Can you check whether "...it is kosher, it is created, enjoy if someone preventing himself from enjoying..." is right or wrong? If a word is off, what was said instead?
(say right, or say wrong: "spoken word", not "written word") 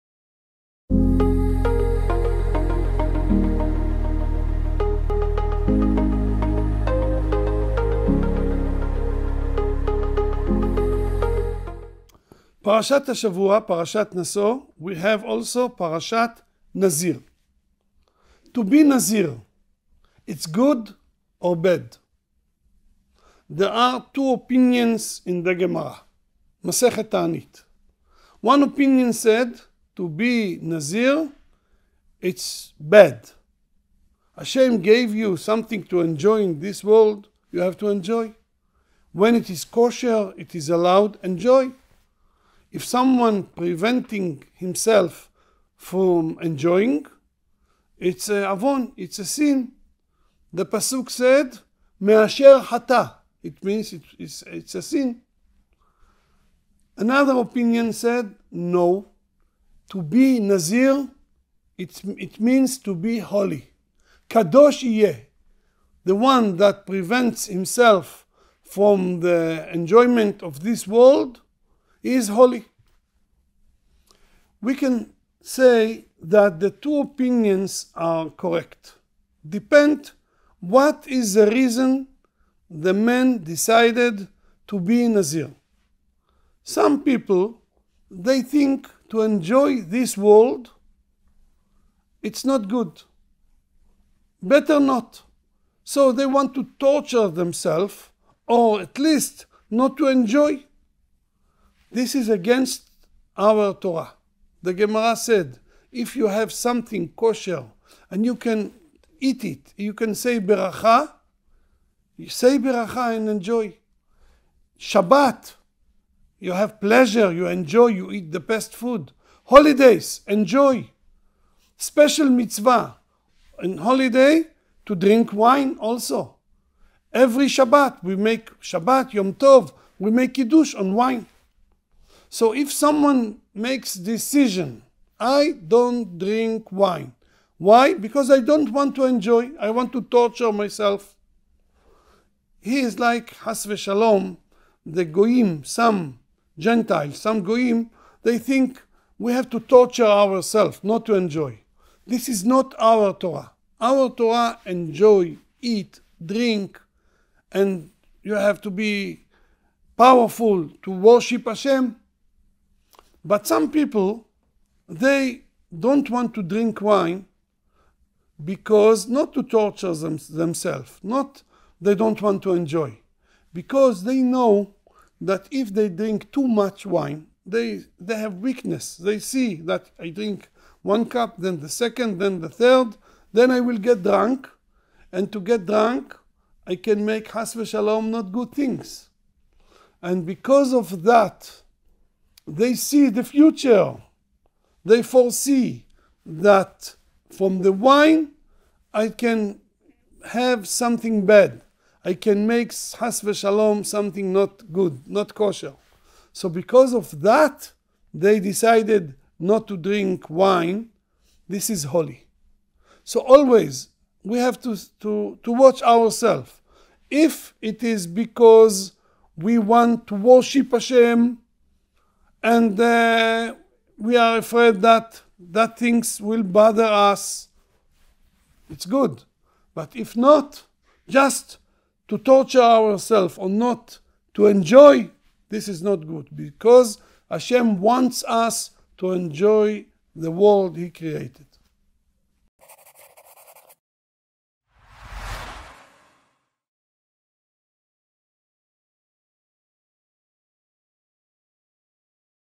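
wrong: "allowed", not "created".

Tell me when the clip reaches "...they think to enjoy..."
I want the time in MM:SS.
01:28.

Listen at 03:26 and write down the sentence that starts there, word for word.
So because of that, they decided not to drink wine.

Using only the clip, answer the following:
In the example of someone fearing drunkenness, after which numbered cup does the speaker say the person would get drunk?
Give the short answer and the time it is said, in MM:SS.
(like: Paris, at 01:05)
Third, at 03:02.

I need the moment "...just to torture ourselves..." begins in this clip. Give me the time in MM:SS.
03:51.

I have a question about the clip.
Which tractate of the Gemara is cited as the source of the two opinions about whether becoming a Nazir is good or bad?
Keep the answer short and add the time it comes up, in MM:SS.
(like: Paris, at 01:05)
Ta'anit, at 00:26.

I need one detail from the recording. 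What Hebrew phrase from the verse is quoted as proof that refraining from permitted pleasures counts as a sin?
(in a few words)
Me'asher hata.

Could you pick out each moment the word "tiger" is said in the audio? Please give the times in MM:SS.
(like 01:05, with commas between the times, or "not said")
not said.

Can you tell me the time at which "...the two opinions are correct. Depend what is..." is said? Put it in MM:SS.
01:16.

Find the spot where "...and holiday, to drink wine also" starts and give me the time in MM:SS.
02:03.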